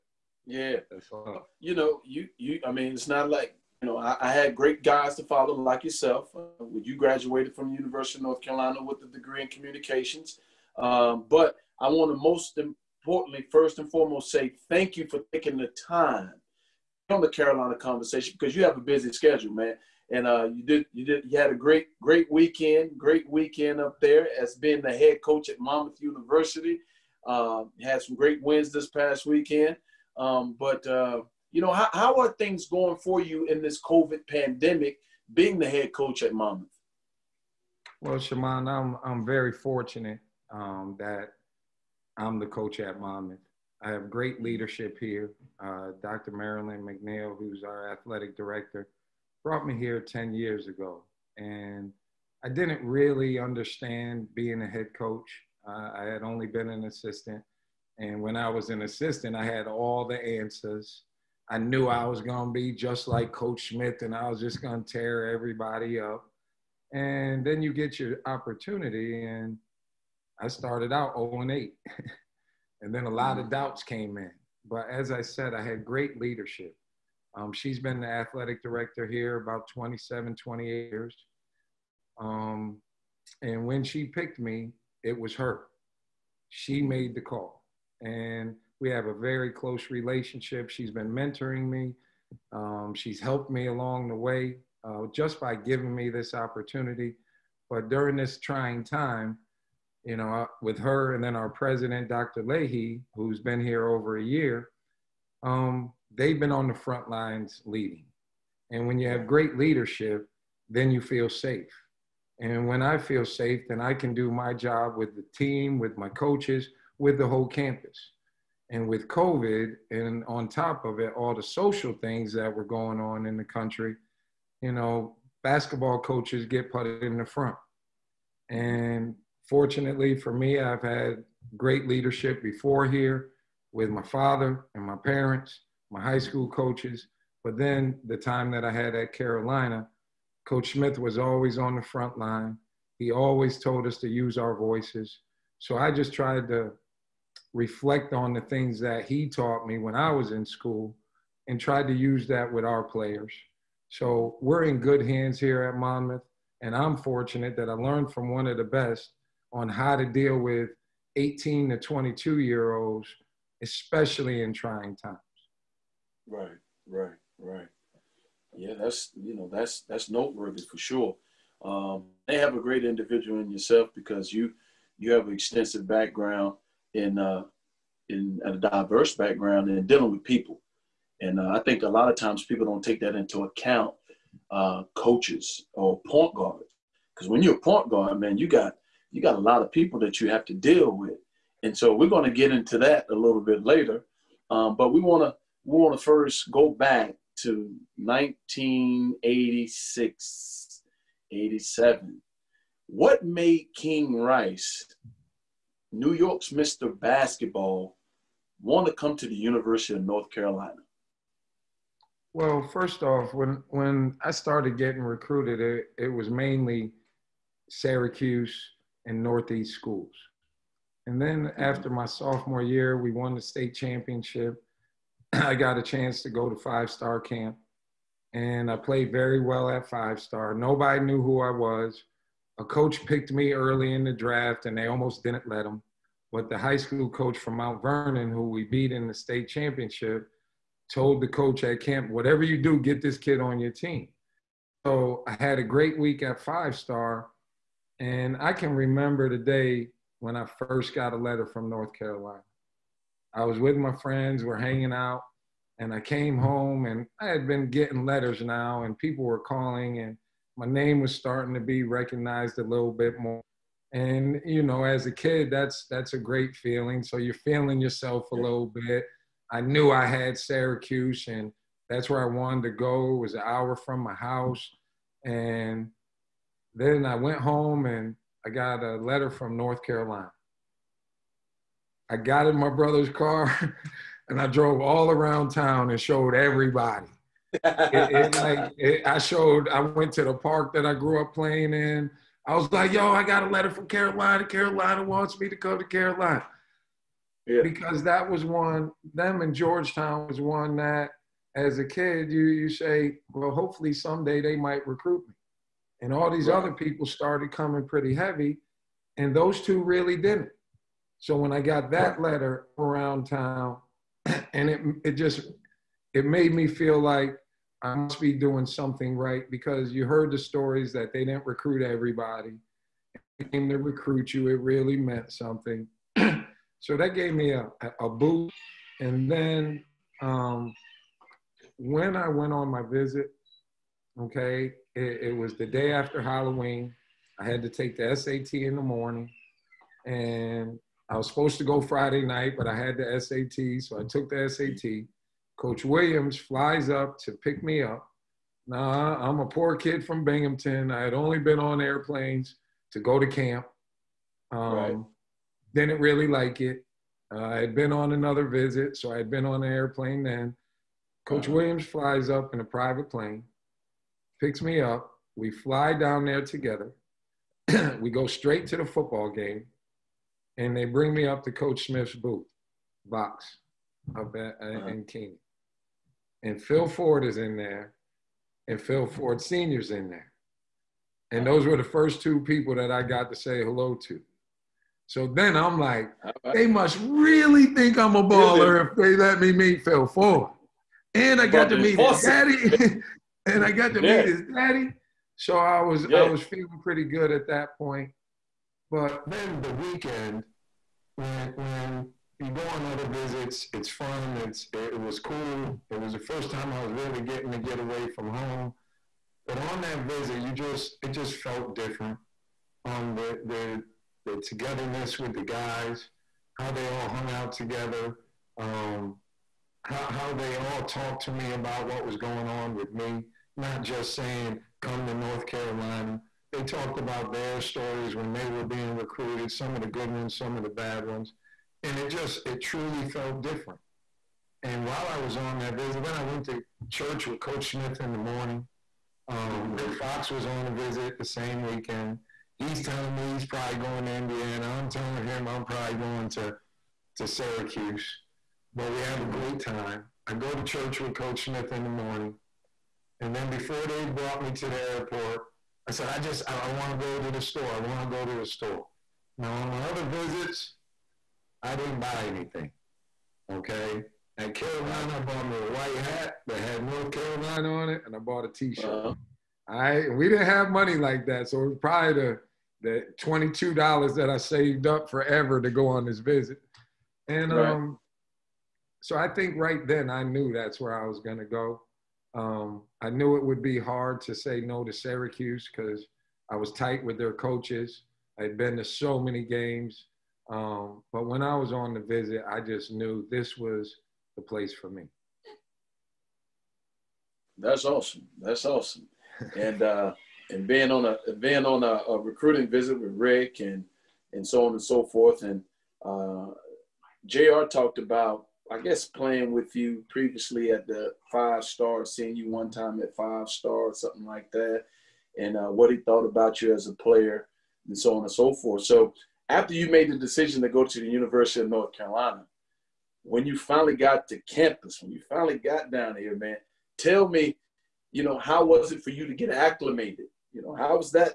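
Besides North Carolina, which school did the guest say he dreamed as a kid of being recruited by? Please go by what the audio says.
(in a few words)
Georgetown.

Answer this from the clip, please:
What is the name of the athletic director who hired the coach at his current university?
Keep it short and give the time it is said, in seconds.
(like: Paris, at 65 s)
Marilyn McNeil, at 46 s.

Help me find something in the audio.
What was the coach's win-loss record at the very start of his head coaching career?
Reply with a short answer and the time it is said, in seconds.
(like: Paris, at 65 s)
0 and 8, at 71 s.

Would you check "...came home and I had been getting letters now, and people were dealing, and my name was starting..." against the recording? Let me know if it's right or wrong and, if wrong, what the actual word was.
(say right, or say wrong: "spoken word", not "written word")
wrong: "calling", not "dealing".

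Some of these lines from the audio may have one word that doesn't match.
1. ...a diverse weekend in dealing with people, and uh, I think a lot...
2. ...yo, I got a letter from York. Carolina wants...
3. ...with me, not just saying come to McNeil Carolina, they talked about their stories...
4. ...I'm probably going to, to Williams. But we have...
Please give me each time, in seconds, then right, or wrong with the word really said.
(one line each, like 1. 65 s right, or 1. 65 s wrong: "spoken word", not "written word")
1. 178 s wrong: "background", not "weekend"
2. 292 s wrong: "Carolina", not "York"
3. 422 s wrong: "North", not "McNeil"
4. 445 s wrong: "Syracuse", not "Williams".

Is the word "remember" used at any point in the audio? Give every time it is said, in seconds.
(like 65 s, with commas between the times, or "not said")
248 s.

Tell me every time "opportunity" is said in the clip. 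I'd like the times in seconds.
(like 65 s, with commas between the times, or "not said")
68 s, 96 s.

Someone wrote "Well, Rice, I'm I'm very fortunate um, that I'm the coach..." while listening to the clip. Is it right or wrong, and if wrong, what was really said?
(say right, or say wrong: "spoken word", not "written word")
wrong: "Shammond", not "Rice".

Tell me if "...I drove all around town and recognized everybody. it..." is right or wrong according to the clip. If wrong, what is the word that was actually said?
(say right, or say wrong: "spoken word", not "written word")
wrong: "showed", not "recognized".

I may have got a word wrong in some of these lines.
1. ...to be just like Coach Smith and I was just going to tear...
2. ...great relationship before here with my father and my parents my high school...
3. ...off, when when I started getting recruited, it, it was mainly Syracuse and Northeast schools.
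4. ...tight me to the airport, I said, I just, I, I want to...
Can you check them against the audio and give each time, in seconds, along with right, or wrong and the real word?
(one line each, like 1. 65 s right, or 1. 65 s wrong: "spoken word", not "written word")
1. 62 s right
2. 131 s wrong: "leadership", not "relationship"
3. 213 s right
4. 454 s wrong: "brought", not "tight".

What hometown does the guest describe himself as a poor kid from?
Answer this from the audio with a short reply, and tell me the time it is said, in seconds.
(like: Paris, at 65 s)
Binghamton, at 350 s.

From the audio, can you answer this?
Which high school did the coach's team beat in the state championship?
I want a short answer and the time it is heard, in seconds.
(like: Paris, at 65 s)
Mount Vernon, at 237 s.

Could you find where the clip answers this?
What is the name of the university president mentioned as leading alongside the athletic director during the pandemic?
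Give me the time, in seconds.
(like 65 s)
102 s.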